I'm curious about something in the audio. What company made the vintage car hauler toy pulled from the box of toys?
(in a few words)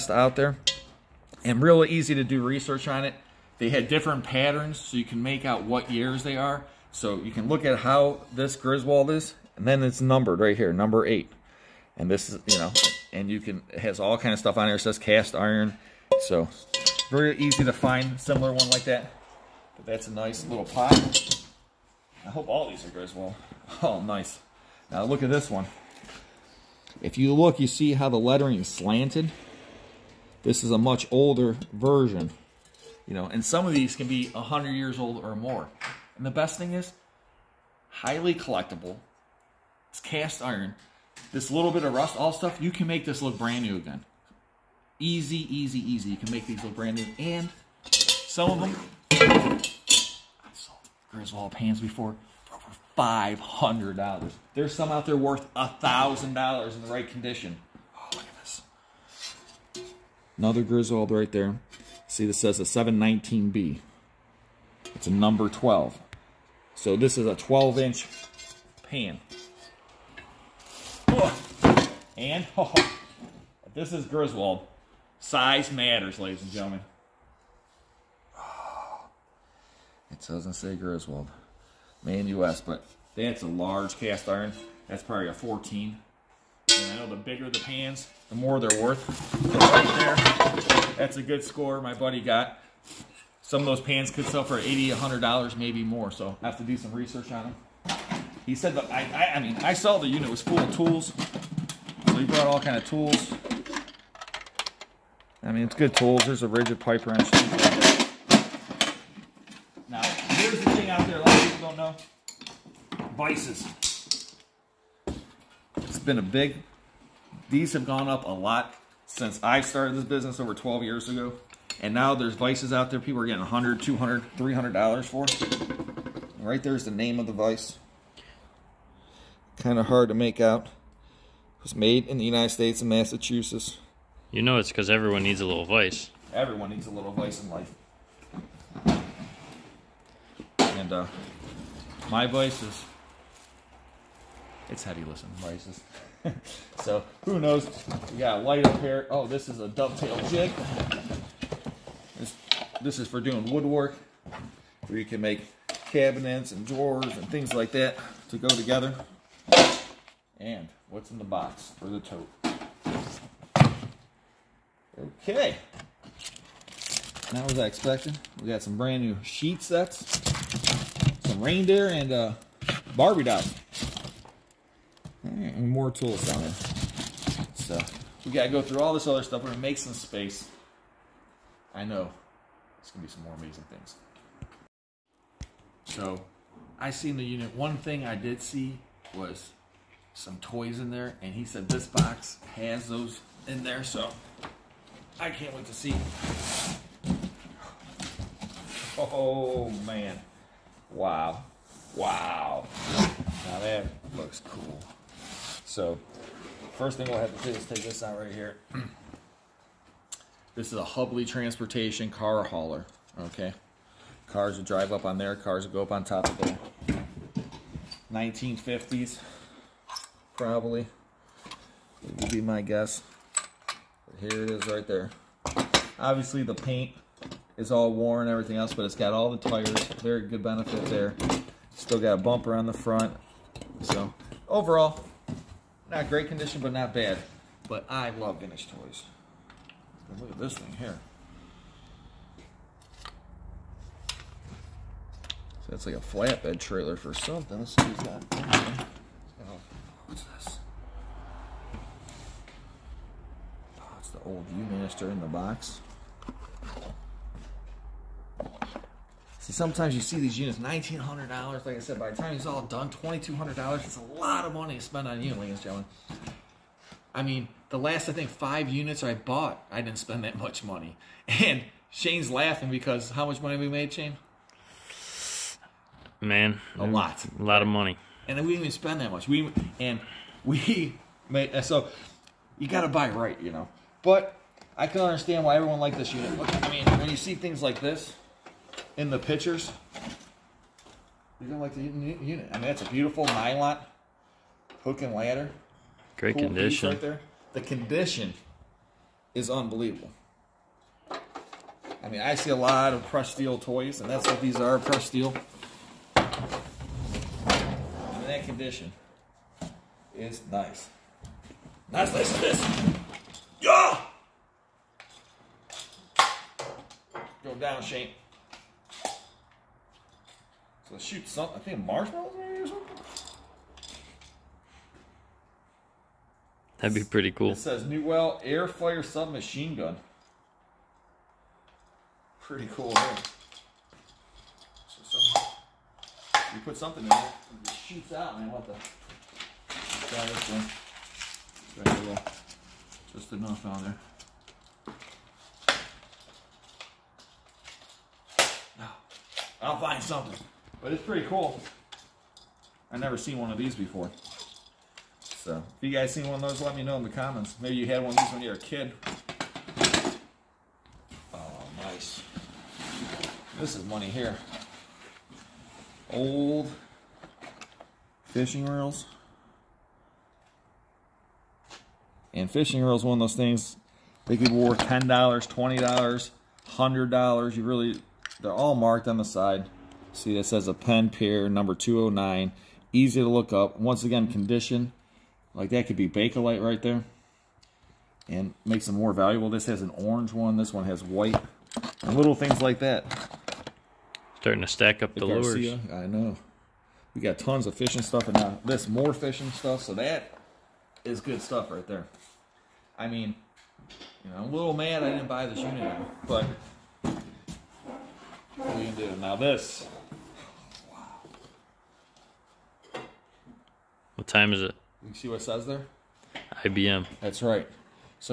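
Hubley.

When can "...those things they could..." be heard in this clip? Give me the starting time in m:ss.
6:13.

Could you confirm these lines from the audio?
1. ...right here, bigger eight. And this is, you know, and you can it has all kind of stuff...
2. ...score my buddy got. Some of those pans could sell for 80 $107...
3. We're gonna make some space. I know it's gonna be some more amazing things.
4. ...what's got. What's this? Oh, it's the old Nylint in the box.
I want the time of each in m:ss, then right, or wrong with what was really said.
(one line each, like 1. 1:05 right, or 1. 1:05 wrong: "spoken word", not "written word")
1. 0:10 wrong: "number", not "bigger"
2. 1:31 wrong: "100", not "107"
3. 2:59 right
4. 4:07 wrong: "Viewmaster", not "Nylint".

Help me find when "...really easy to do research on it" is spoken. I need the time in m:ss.
0:01.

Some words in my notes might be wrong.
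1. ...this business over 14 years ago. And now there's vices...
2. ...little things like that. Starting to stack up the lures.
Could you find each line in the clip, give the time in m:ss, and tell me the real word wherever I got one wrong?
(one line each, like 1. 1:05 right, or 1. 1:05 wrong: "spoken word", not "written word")
1. 1:59 wrong: "12", not "14"
2. 6:32 right.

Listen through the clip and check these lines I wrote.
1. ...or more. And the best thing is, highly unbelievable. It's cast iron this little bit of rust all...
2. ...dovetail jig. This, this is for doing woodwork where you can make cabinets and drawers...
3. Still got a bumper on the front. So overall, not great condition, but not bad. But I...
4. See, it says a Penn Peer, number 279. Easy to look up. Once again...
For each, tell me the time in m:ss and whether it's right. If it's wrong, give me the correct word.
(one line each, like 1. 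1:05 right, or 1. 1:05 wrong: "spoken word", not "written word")
1. 0:35 wrong: "collectible", not "unbelievable"
2. 2:29 right
3. 3:51 right
4. 6:20 wrong: "209", not "279".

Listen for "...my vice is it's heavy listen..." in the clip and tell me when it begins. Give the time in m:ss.
2:22.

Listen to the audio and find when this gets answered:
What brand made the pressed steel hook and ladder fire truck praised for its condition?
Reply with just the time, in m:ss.
4:53.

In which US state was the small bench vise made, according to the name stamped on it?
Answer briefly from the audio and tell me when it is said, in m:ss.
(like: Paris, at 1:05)
Massachusetts, at 2:12.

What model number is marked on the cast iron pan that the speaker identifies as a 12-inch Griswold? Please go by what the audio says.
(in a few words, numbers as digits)
719B.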